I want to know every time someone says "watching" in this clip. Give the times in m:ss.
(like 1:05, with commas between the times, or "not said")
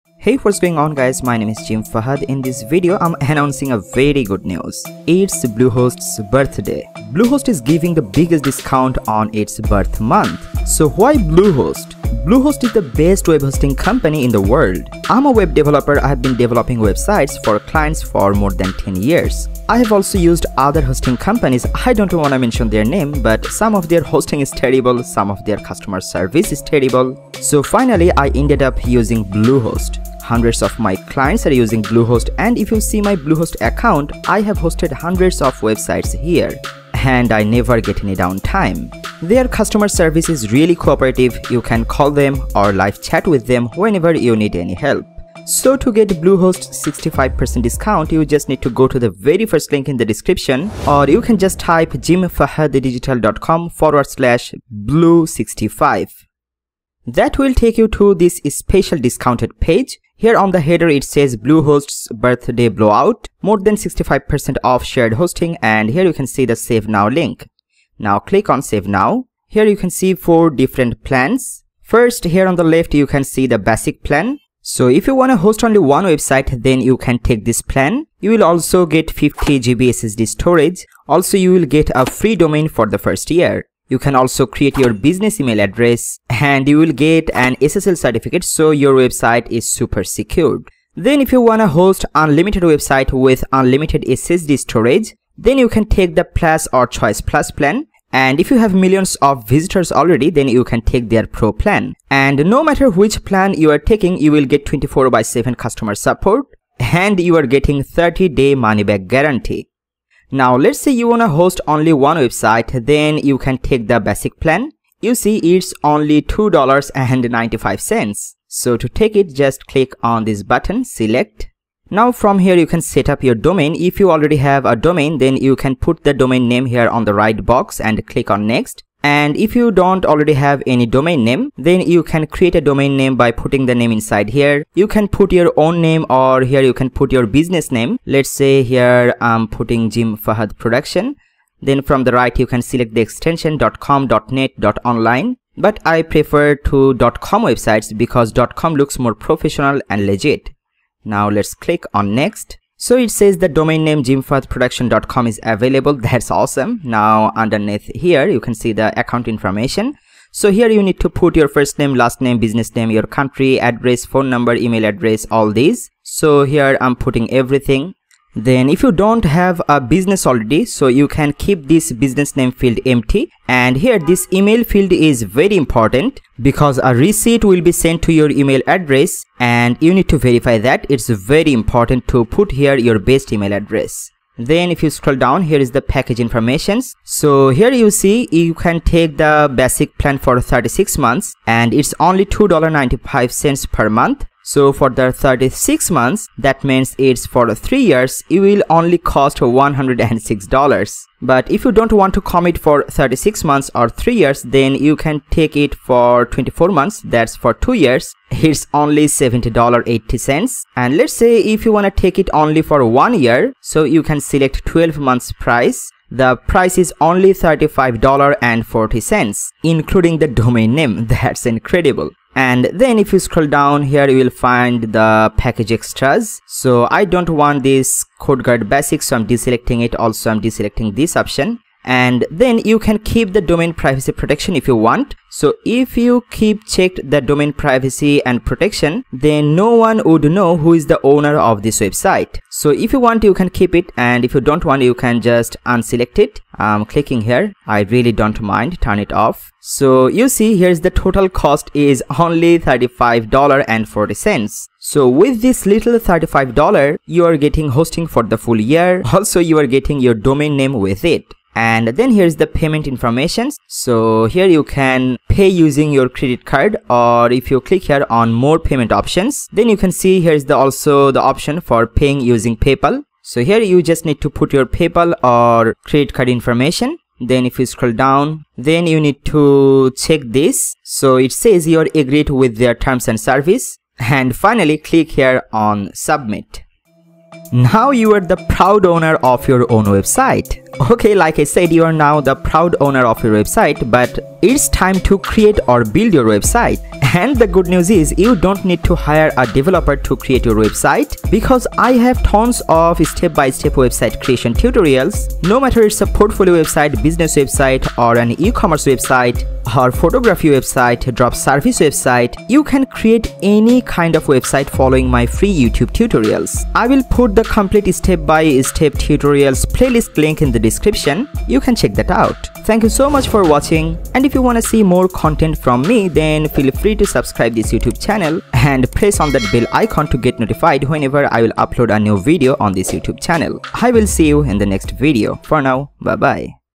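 5:23.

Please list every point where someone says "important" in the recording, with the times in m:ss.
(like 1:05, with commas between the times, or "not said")
2:55, 3:01.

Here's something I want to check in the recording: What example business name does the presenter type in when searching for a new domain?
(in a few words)
Jim Fahad Production.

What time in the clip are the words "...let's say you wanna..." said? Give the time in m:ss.
1:50.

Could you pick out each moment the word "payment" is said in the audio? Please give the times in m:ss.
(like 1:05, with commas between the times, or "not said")
4:22, 4:28.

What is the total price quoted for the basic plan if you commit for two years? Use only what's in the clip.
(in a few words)
$70.80.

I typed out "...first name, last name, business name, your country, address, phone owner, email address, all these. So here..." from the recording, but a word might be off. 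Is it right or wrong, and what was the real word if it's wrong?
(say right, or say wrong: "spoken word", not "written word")
wrong: "number", not "owner".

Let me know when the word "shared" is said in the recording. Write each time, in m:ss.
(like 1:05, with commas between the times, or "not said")
1:04.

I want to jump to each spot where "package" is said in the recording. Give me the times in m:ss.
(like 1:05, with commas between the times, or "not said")
3:05, 3:45.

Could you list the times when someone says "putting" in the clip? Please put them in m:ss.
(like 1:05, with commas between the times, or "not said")
2:13, 2:19, 2:46.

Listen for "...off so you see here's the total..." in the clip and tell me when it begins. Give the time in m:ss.
4:09.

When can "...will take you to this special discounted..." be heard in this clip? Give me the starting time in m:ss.
0:57.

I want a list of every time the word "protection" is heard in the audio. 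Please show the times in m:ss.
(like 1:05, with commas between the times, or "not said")
3:54, 3:58.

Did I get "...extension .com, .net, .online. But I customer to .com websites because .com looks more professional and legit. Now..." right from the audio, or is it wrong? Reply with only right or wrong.
wrong.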